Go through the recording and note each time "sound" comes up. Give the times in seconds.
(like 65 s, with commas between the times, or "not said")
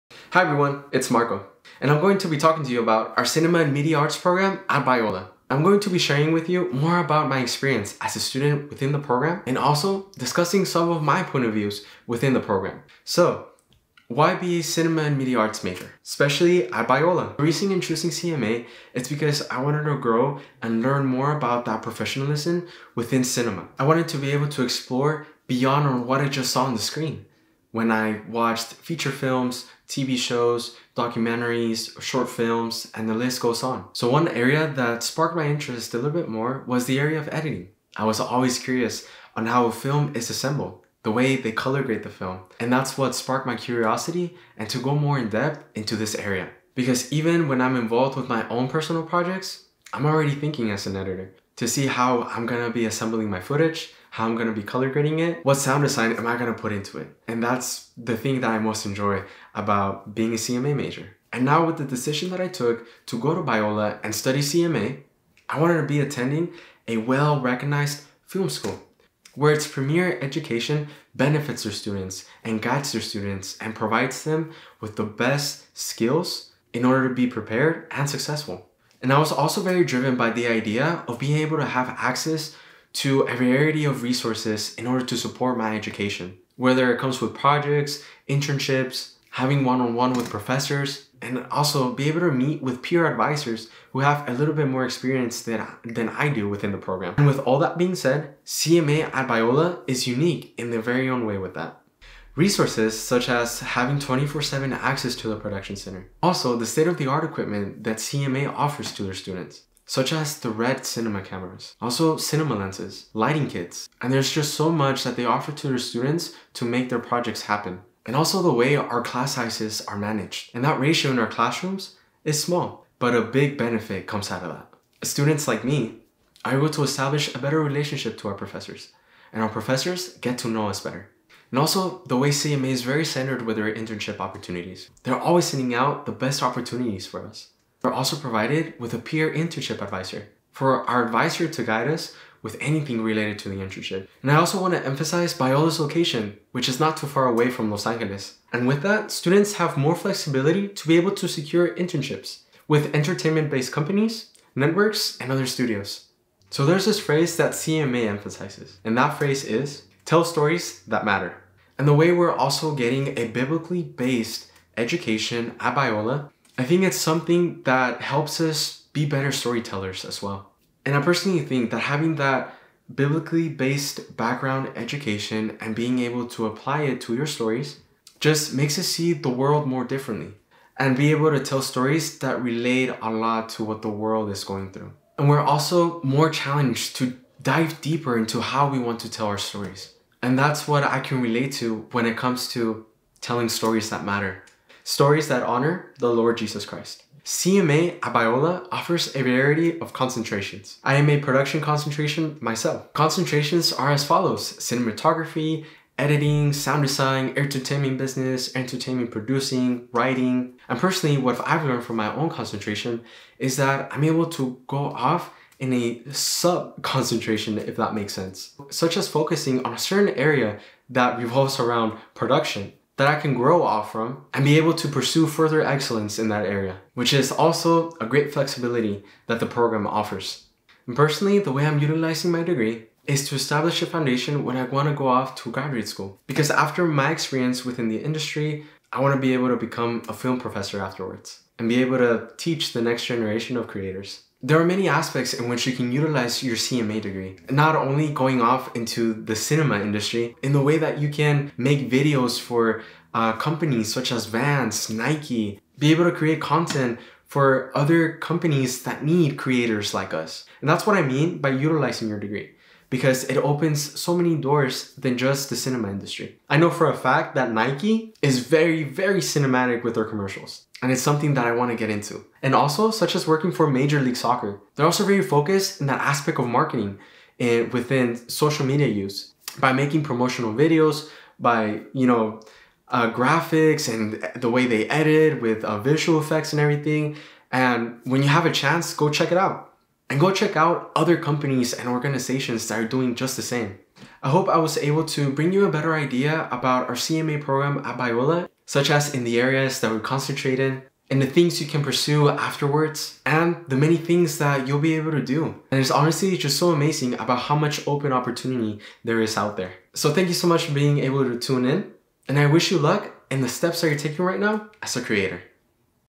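55 s, 206 s.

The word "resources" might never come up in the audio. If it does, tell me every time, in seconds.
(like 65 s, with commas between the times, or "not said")
84 s, 102 s.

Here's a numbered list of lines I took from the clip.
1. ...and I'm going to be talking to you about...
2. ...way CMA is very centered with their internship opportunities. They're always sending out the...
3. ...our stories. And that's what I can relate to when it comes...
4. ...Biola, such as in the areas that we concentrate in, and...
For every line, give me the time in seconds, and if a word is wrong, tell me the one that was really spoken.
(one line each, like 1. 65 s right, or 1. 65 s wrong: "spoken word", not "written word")
1. 1 s right
2. 132 s right
3. 189 s right
4. 297 s right.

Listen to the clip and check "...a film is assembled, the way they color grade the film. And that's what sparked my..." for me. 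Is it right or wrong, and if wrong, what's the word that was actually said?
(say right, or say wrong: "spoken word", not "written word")
right.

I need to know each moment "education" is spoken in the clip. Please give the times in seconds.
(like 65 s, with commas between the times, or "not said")
70 s, 85 s, 164 s, 174 s.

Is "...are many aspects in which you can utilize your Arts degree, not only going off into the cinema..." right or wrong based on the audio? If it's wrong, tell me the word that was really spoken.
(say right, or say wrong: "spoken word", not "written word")
wrong: "CMA", not "Arts".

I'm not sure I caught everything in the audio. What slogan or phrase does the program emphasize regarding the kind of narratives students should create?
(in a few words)
Tell stories that matter.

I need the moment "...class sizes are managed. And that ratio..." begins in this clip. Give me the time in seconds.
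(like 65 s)
119 s.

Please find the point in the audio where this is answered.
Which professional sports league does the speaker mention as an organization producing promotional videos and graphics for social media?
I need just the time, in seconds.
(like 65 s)
273 s.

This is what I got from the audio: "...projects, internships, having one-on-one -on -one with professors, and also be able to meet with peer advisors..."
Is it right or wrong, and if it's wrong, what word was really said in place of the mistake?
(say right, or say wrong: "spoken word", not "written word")
right.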